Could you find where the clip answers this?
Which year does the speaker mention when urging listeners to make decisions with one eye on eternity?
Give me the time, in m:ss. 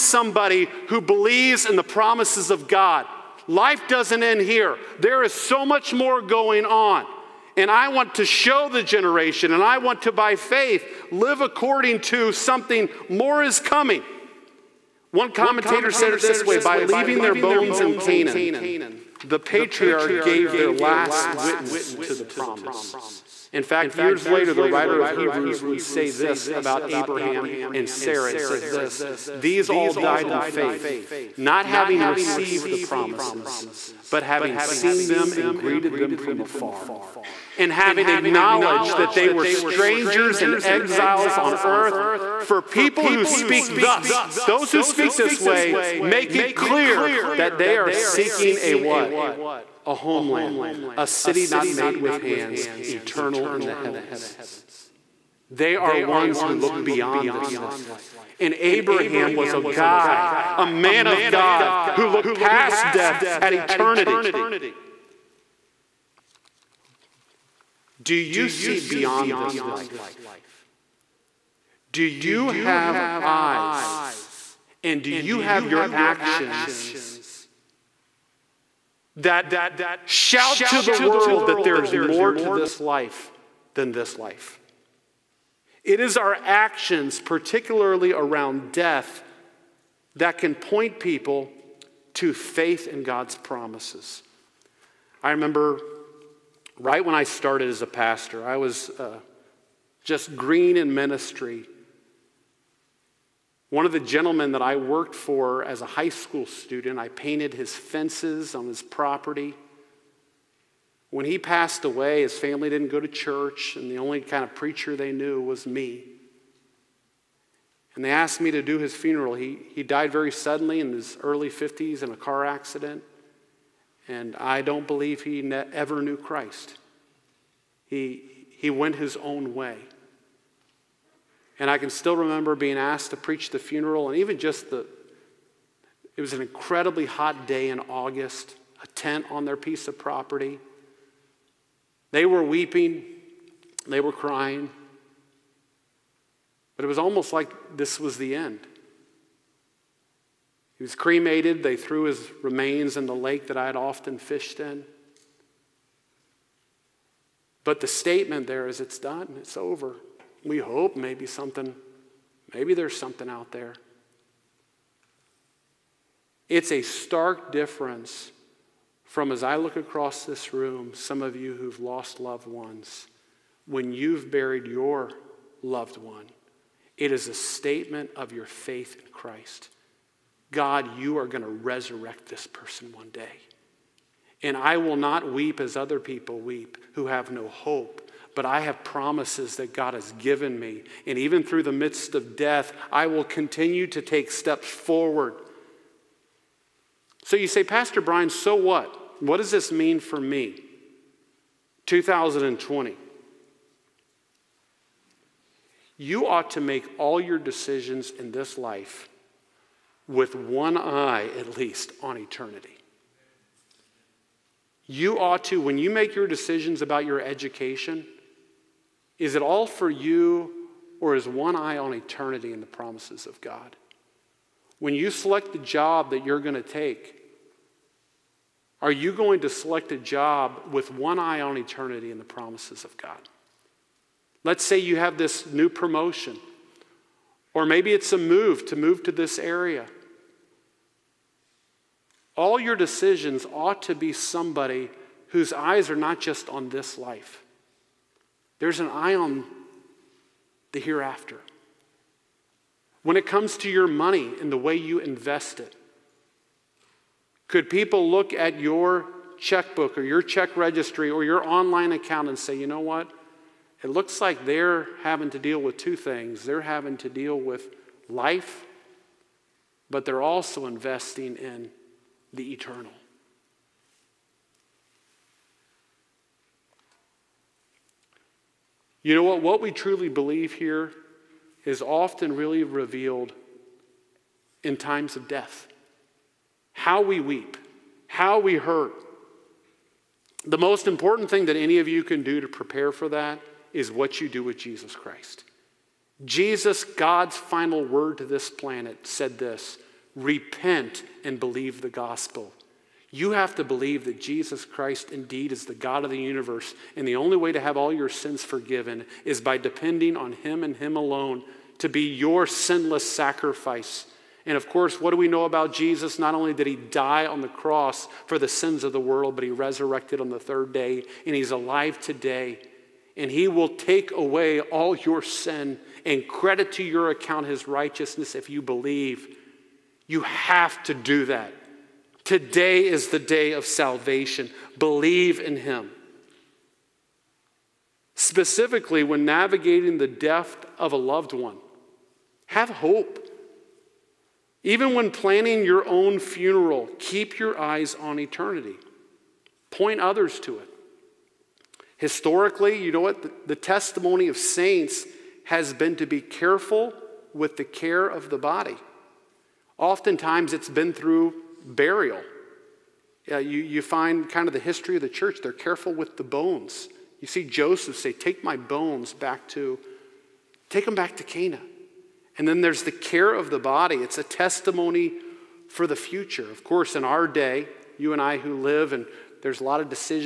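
3:21.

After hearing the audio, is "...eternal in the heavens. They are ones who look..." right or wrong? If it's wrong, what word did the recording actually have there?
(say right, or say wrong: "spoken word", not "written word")
right.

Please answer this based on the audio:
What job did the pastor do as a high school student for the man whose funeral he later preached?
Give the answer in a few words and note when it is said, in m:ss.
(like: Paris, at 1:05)
Painted his fences, at 1:47.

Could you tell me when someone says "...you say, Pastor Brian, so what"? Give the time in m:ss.
3:17.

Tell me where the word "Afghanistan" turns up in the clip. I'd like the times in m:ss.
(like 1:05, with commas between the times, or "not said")
not said.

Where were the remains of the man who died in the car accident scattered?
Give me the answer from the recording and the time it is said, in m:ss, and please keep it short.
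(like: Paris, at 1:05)
In the lake, at 2:33.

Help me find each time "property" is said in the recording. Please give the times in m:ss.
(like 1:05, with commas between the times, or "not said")
1:48, 2:19.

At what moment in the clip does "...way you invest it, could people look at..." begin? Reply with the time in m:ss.
4:14.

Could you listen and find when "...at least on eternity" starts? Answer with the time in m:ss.
3:31.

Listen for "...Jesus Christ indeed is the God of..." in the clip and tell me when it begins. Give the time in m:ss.
5:04.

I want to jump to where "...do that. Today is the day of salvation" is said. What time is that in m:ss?
5:30.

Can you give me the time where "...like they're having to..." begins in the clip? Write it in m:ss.
4:24.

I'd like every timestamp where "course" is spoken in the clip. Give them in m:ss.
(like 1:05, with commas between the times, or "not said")
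5:14, 6:16.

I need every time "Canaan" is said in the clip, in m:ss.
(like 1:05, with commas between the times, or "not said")
0:17, 6:11.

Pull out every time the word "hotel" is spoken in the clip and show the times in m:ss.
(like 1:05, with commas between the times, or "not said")
not said.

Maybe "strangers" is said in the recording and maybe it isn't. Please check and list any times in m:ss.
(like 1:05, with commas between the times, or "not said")
0:39.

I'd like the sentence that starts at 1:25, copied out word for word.
It is our actions, particularly around death, that can point people to faith in God's promises.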